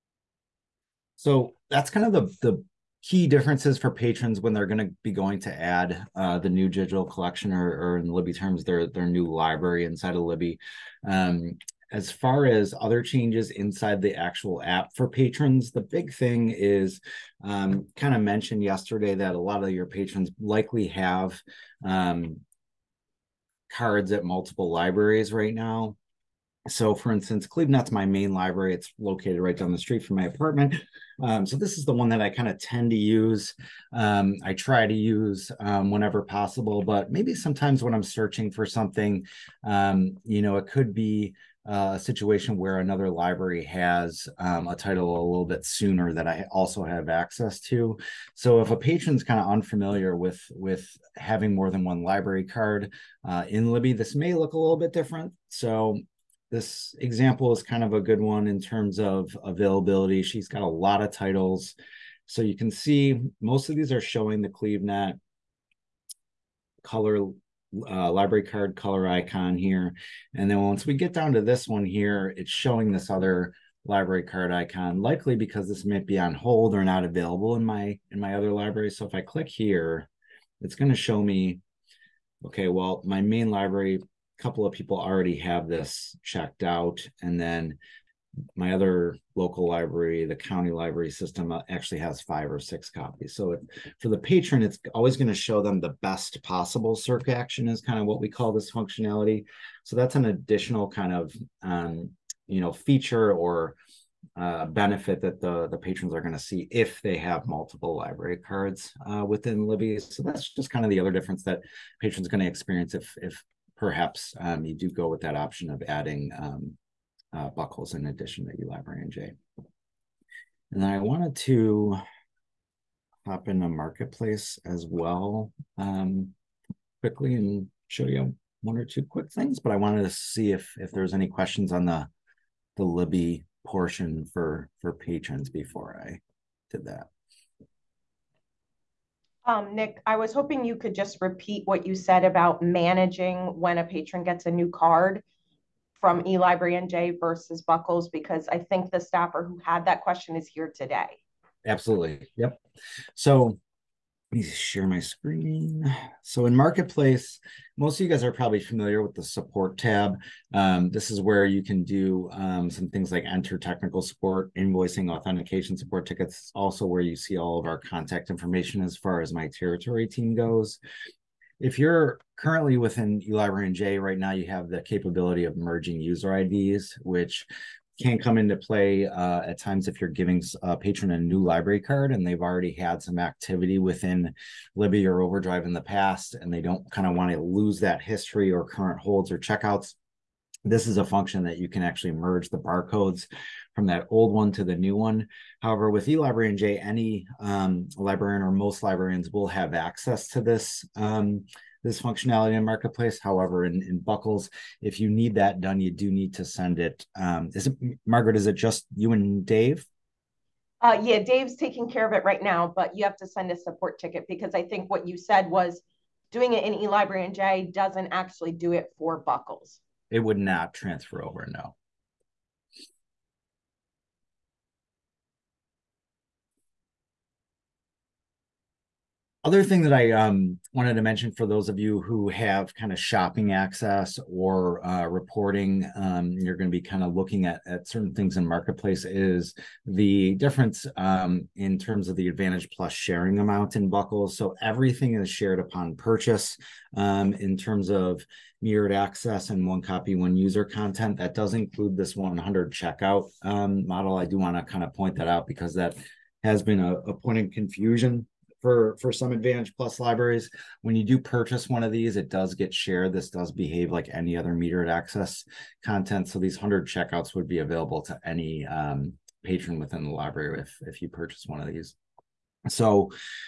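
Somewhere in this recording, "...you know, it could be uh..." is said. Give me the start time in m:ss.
0:40.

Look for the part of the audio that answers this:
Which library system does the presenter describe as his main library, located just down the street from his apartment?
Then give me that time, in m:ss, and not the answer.
0:27.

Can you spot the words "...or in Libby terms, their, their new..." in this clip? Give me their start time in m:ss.
0:07.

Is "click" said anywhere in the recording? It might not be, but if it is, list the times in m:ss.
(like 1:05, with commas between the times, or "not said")
1:19.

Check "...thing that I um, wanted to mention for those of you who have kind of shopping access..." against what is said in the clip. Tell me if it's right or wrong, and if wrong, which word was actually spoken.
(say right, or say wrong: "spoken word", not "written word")
right.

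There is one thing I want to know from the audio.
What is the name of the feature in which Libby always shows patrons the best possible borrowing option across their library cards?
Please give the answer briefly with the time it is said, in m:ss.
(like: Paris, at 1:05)
best possible circ action, at 1:36.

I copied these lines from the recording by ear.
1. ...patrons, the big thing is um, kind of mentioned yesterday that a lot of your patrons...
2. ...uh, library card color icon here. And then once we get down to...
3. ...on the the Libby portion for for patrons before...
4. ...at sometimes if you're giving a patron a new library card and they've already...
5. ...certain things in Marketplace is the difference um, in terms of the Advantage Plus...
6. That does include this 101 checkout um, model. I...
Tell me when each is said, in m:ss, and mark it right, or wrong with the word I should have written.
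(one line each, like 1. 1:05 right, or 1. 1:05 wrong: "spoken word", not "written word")
1. 0:15 right
2. 1:07 right
3. 2:11 right
4. 2:59 wrong: "times", not "sometimes"
5. 3:57 right
6. 4:11 wrong: "100", not "101".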